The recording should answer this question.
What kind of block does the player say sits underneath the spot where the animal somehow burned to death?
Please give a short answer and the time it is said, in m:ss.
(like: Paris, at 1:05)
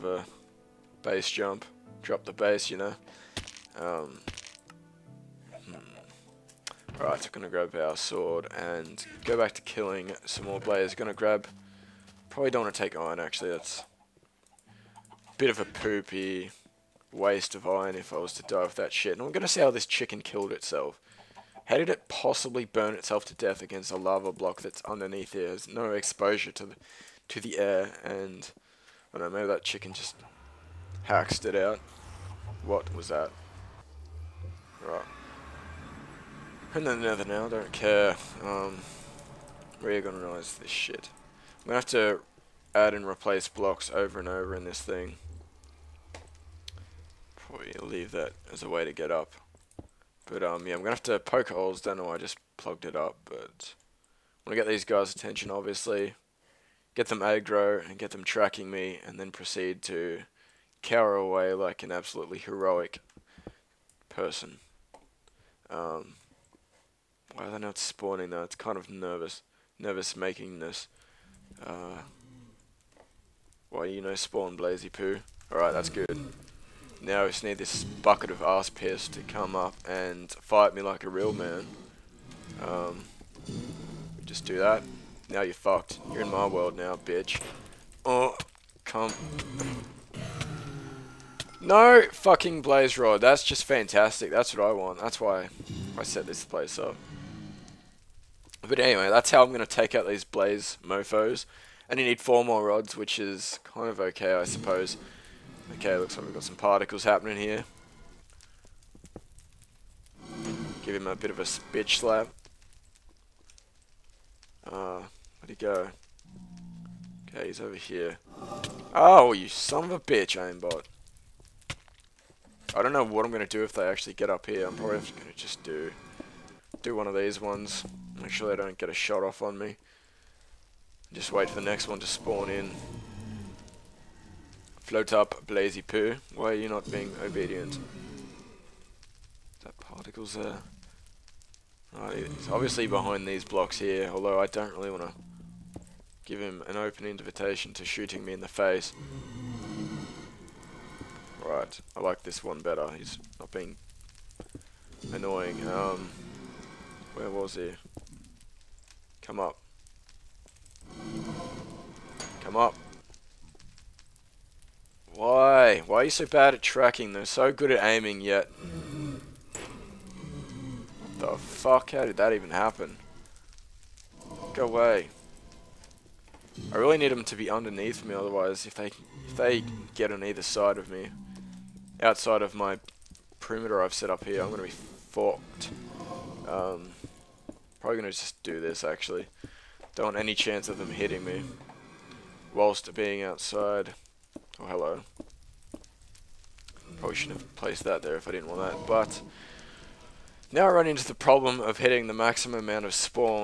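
Lava block, at 0:23.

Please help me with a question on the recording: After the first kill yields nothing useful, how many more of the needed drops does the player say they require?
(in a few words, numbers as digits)
4.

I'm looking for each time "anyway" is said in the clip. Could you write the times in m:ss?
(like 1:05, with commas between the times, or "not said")
1:38.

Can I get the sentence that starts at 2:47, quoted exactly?
They're so good at aiming, yet...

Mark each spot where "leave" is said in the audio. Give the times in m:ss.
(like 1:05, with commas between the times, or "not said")
0:47.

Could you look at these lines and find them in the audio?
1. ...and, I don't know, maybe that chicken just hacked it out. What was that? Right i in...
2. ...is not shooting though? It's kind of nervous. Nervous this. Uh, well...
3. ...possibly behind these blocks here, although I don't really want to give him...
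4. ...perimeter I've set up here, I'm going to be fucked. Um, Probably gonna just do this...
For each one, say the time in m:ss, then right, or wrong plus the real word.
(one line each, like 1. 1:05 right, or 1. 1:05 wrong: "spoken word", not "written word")
1. 0:28 right
2. 1:07 wrong: "spawning", not "shooting"
3. 2:22 wrong: "obviously", not "possibly"
4. 3:03 right.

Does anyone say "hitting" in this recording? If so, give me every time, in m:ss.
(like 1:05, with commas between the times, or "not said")
3:10, 3:21.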